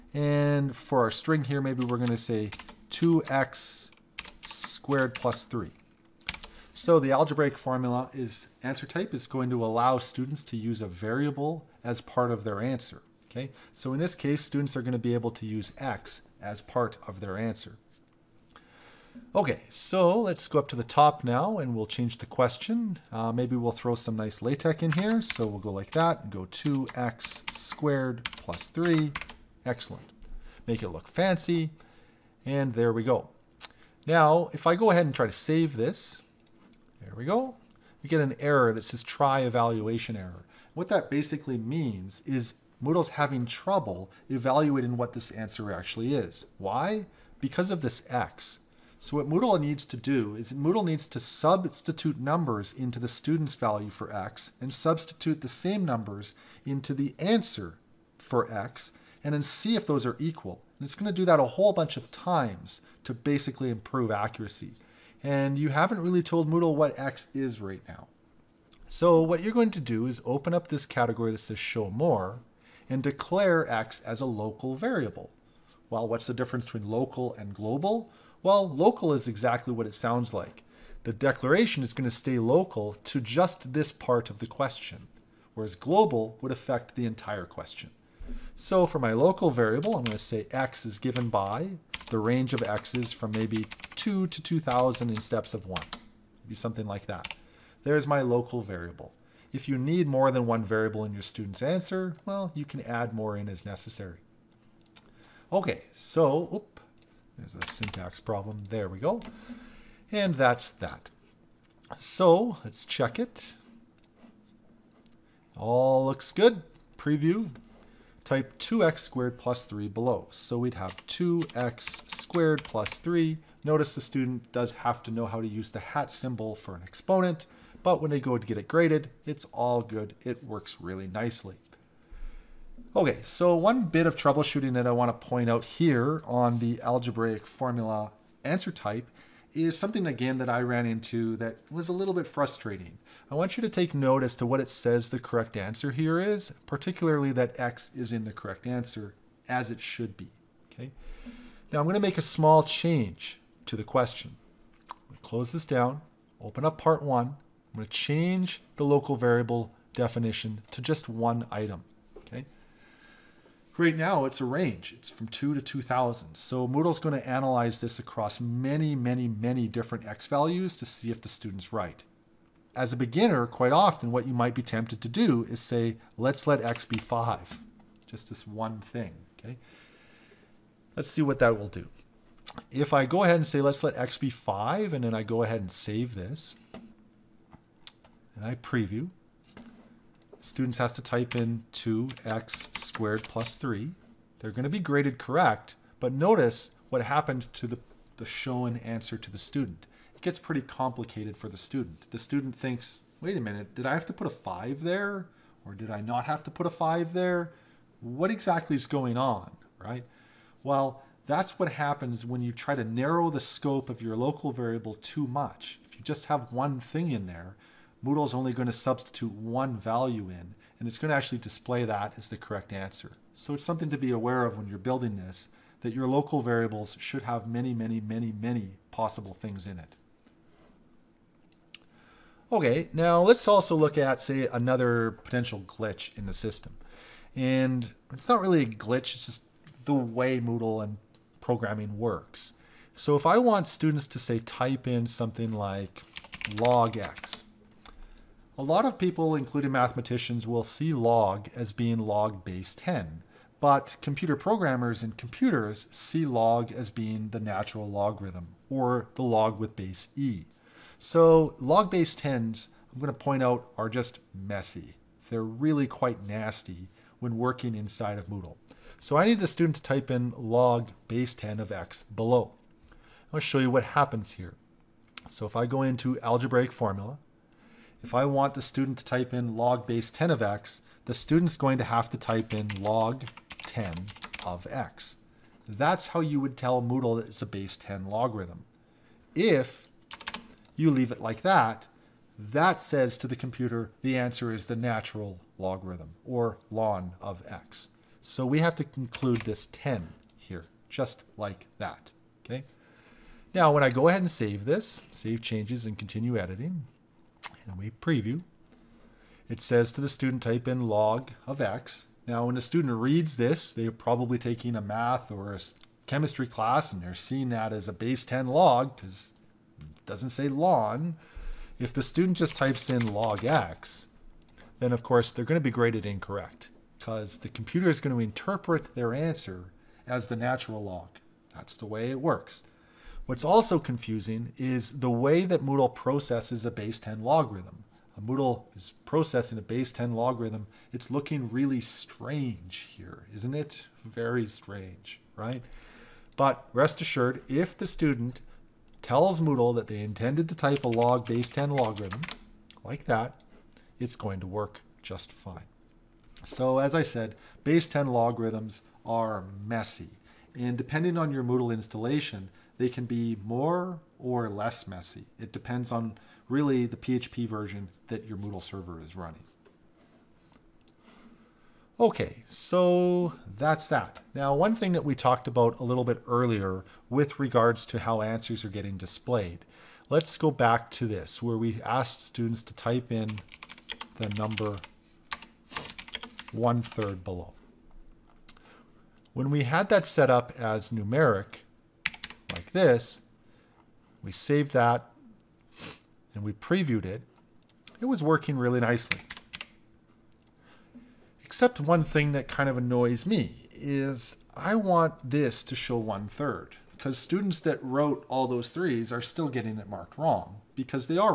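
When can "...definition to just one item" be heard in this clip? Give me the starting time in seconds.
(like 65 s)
159 s.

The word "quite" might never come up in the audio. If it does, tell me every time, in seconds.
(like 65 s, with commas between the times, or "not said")
173 s, 265 s.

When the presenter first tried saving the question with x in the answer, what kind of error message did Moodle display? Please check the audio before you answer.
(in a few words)
Try evaluation error.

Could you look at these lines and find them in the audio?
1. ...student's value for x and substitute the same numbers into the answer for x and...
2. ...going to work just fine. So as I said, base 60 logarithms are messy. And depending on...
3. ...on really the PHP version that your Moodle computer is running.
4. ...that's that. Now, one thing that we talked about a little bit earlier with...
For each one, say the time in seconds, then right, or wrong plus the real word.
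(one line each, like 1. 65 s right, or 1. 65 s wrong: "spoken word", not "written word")
1. 53 s right
2. 354 s wrong: "10", not "60"
3. 365 s wrong: "server", not "computer"
4. 373 s right.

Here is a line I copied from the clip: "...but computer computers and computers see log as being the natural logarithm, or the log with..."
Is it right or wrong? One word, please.
wrong.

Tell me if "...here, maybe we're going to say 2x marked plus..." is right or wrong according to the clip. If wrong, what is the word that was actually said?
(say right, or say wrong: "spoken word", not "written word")
wrong: "squared", not "marked".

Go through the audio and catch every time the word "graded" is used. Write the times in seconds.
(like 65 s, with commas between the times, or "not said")
128 s, 194 s, 325 s.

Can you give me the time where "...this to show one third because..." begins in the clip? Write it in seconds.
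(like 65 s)
405 s.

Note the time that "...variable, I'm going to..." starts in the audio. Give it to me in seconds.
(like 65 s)
89 s.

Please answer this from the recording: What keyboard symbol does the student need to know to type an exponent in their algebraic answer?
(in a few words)
Hat symbol.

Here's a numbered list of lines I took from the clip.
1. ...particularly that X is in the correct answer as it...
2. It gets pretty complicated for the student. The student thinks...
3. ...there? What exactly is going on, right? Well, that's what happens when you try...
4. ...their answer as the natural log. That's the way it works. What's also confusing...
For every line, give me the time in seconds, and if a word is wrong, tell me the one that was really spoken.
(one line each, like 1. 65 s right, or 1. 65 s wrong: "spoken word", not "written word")
1. 146 s right
2. 200 s right
3. 207 s right
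4. 328 s right.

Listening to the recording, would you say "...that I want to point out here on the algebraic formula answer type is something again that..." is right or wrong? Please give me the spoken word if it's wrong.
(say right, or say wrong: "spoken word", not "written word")
right.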